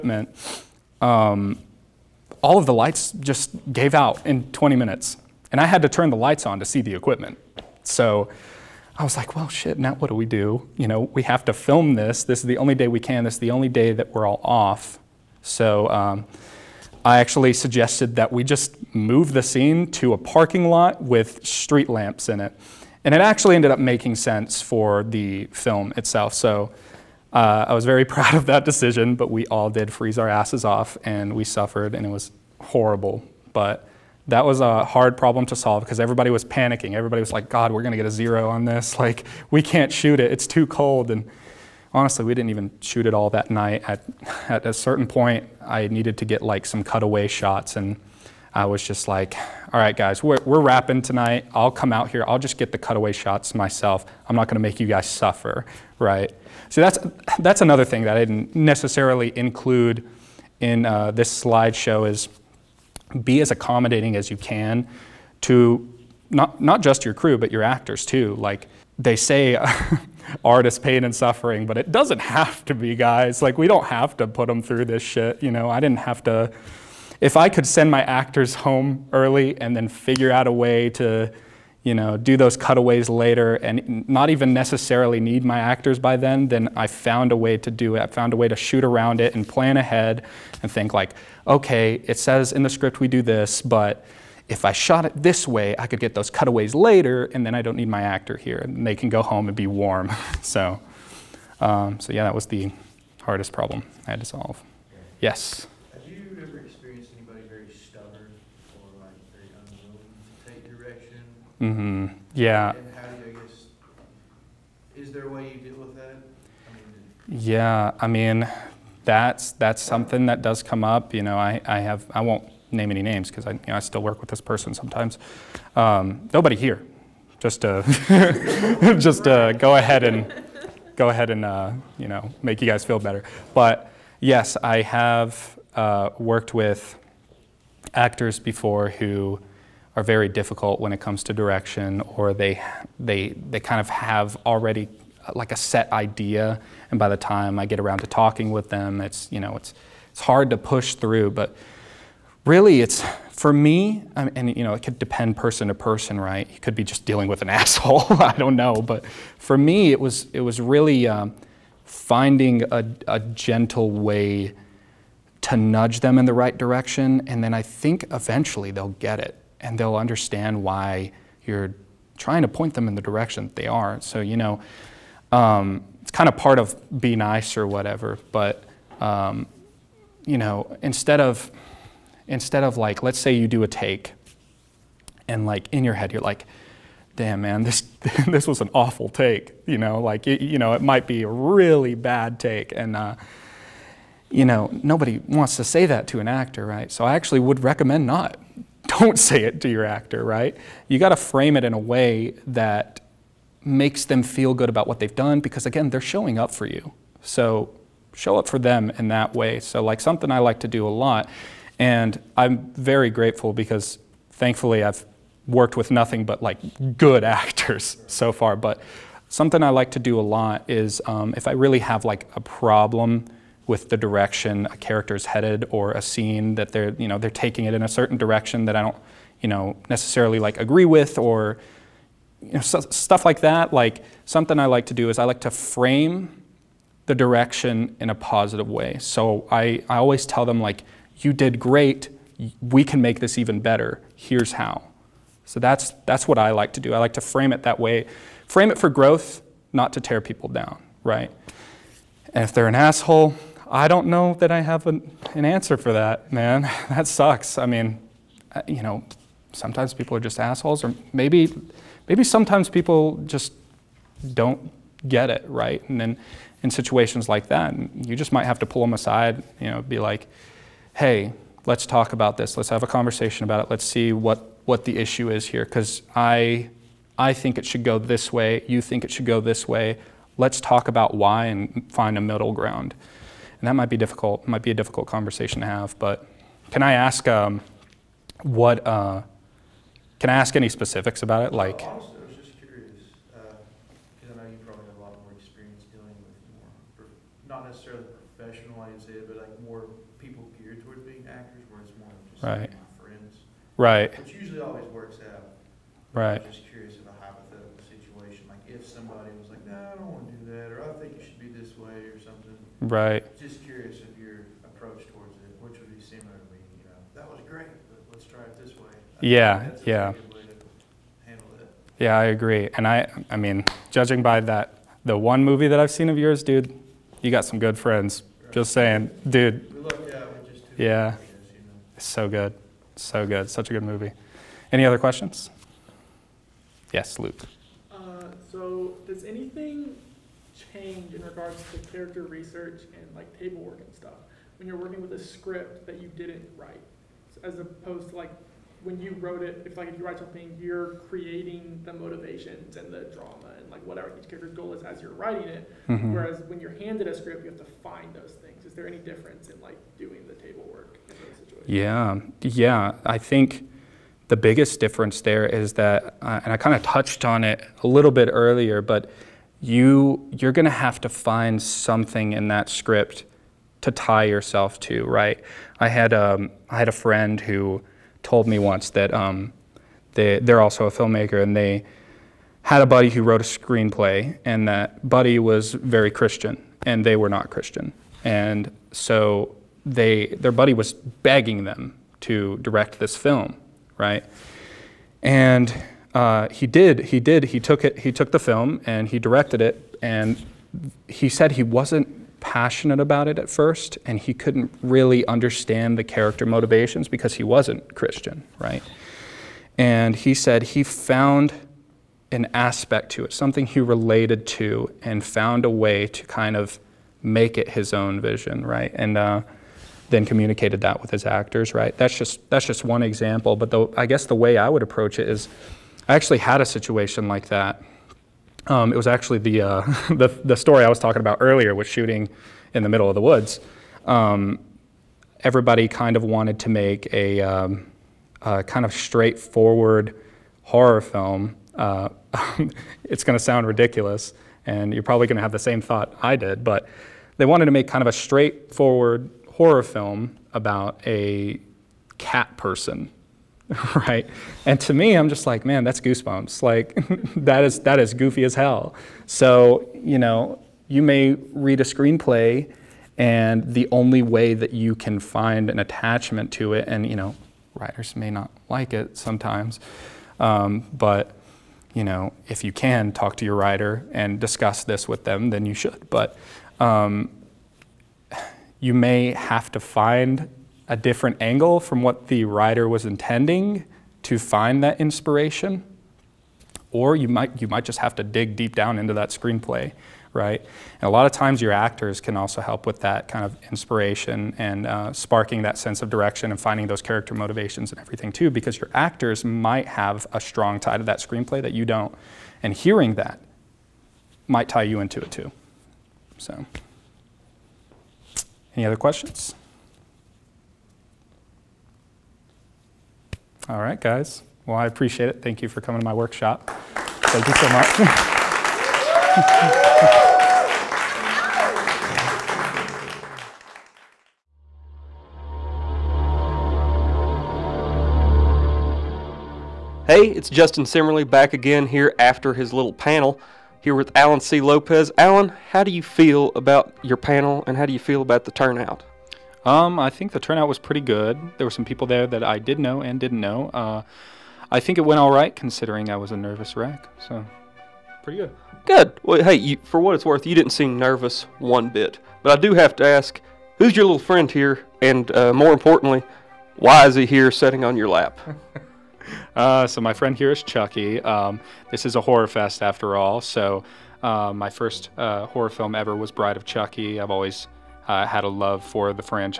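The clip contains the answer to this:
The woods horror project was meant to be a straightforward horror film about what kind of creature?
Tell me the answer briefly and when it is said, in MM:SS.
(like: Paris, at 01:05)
a cat person, at 07:32.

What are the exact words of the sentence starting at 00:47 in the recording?
And I was just like, all right, guys, we're, we're wrapping tonight.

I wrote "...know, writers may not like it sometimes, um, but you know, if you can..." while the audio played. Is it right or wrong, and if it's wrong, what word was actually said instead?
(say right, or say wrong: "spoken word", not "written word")
right.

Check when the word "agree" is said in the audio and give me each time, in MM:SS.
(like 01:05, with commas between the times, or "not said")
03:50, 05:22.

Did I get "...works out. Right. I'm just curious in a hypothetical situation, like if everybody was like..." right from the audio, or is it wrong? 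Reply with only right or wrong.
wrong.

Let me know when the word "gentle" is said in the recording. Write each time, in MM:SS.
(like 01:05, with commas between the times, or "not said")
02:43.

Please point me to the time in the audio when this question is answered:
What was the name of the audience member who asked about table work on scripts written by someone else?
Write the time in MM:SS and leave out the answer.
05:37.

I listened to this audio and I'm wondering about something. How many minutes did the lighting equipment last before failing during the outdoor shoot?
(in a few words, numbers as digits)
20.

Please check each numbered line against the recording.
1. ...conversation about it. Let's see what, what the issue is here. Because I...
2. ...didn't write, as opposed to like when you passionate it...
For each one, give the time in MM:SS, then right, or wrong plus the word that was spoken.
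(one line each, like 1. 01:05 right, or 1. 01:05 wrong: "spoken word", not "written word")
1. 04:32 right
2. 05:46 wrong: "wrote", not "passionate".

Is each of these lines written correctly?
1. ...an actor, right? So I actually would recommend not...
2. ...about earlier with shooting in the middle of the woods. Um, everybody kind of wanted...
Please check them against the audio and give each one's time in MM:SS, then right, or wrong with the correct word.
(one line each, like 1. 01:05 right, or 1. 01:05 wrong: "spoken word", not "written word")
1. 03:16 right
2. 07:11 right.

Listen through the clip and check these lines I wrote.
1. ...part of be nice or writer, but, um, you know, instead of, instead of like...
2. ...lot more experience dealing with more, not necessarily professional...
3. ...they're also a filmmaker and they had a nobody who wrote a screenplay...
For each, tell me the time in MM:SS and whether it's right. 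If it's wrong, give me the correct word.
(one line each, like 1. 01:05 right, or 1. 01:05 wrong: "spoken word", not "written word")
1. 02:56 wrong: "whatever", not "writer"
2. 04:55 right
3. 06:20 wrong: "buddy", not "nobody".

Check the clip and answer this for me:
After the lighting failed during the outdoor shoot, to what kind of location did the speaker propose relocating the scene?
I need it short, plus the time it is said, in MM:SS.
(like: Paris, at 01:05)
parking lot, at 00:20.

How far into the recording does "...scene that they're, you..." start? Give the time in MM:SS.
03:46.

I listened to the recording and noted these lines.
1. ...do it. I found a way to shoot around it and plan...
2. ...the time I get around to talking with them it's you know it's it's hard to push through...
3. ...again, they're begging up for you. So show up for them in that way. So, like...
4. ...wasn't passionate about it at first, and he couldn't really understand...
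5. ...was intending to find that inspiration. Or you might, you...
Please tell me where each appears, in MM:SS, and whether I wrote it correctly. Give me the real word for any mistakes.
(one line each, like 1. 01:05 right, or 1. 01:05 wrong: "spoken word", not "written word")
1. 01:27 right
2. 02:27 right
3. 03:25 wrong: "showing", not "begging"
4. 06:41 right
5. 08:02 right.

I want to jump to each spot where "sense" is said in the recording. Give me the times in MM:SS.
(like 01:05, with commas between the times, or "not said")
00:24, 08:15.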